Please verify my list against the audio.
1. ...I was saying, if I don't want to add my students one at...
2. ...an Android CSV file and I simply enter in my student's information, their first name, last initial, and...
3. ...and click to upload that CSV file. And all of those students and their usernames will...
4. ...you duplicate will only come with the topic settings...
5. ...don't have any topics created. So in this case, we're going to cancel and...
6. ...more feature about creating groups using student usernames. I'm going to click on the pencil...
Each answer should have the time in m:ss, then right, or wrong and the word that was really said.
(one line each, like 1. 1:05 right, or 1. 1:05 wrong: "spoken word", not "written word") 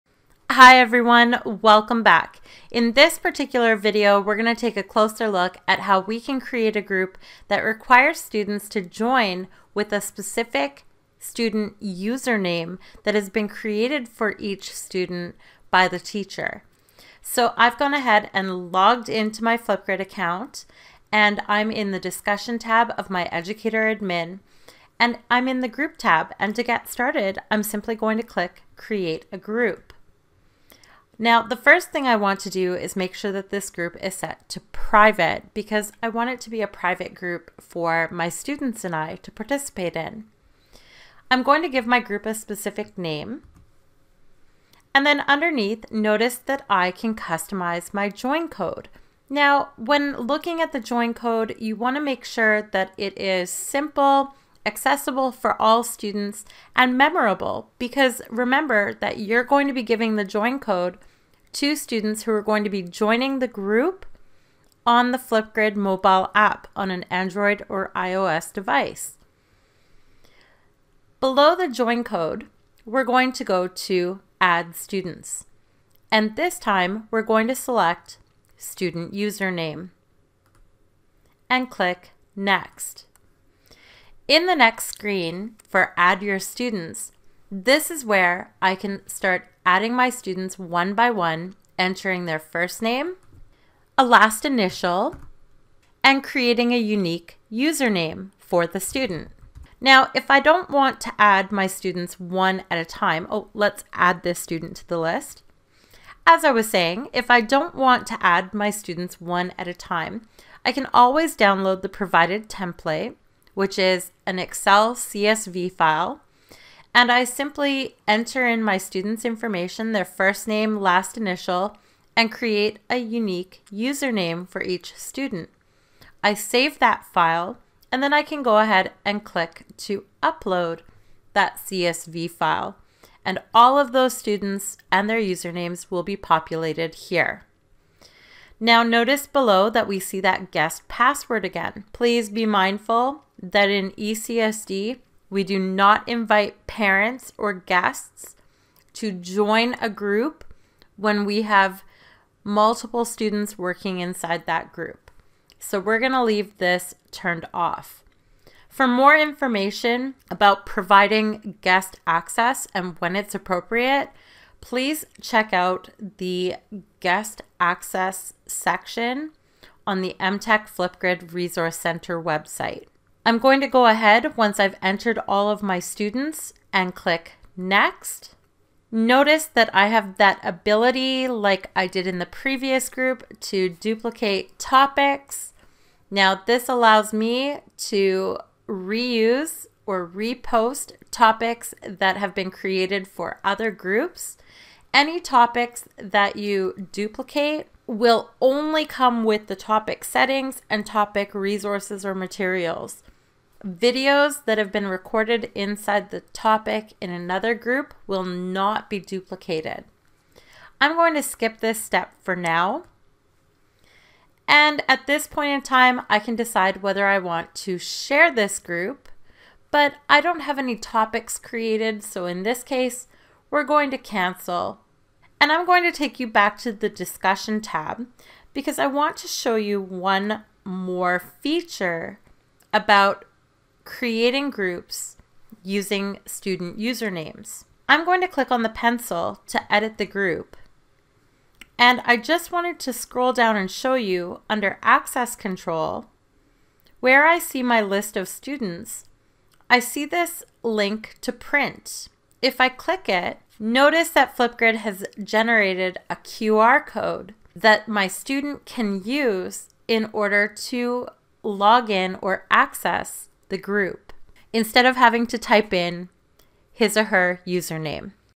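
1. 1:46 right
2. 1:54 wrong: "Excel", not "Android"
3. 2:09 right
4. 3:16 right
5. 3:40 right
6. 3:50 right.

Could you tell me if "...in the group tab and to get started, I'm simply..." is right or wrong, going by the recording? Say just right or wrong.
right.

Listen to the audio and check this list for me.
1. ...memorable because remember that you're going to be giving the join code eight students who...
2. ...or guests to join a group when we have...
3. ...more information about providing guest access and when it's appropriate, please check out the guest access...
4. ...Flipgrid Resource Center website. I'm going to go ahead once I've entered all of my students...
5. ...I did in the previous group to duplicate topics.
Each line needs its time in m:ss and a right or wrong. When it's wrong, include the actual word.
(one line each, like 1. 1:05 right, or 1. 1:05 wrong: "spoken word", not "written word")
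1. 0:56 wrong: "two", not "eight"
2. 2:27 right
3. 2:38 right
4. 2:50 right
5. 3:01 right.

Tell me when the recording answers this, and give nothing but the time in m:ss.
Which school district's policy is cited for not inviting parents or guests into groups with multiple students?
2:23.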